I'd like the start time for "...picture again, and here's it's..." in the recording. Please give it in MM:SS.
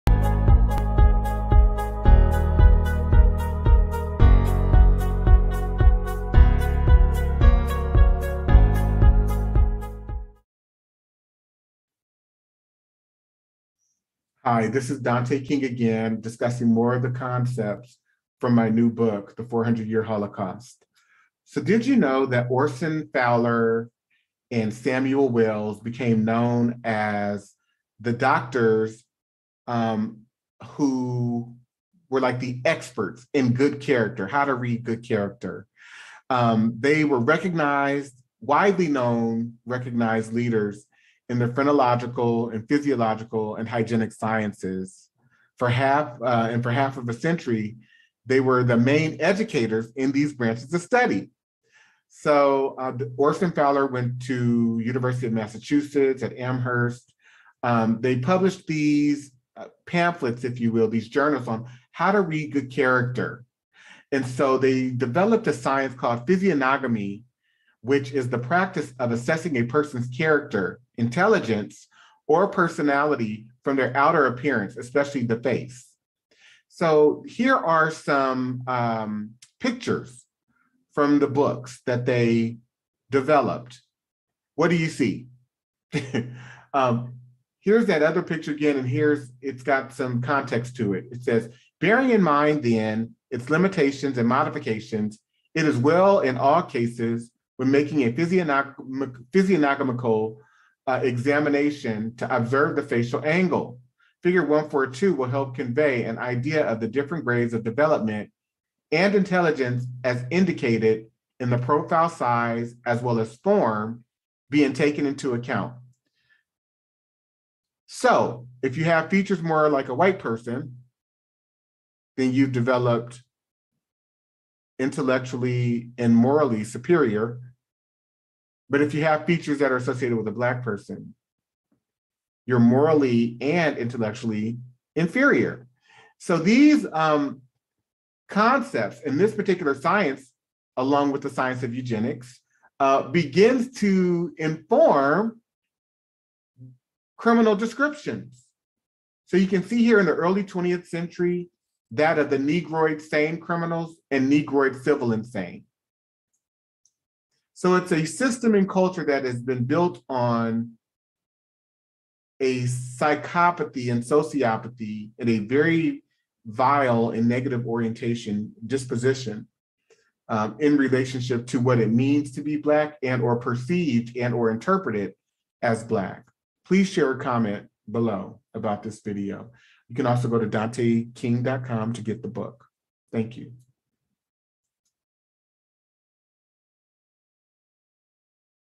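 01:28.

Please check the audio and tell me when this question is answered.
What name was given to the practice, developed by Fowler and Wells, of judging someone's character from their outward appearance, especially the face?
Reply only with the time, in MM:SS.
01:06.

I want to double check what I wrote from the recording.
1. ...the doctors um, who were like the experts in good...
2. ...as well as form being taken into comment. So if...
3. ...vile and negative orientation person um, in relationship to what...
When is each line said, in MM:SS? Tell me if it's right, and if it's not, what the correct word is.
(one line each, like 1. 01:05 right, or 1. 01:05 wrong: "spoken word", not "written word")
1. 00:27 right
2. 01:52 wrong: "account", not "comment"
3. 02:46 wrong: "disposition", not "person".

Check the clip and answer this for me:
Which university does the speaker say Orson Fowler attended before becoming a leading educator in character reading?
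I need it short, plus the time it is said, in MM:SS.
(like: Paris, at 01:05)
University of Massachusetts at Amherst, at 00:54.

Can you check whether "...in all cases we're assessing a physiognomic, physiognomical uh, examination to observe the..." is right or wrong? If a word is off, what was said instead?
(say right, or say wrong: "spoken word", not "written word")
wrong: "making", not "assessing".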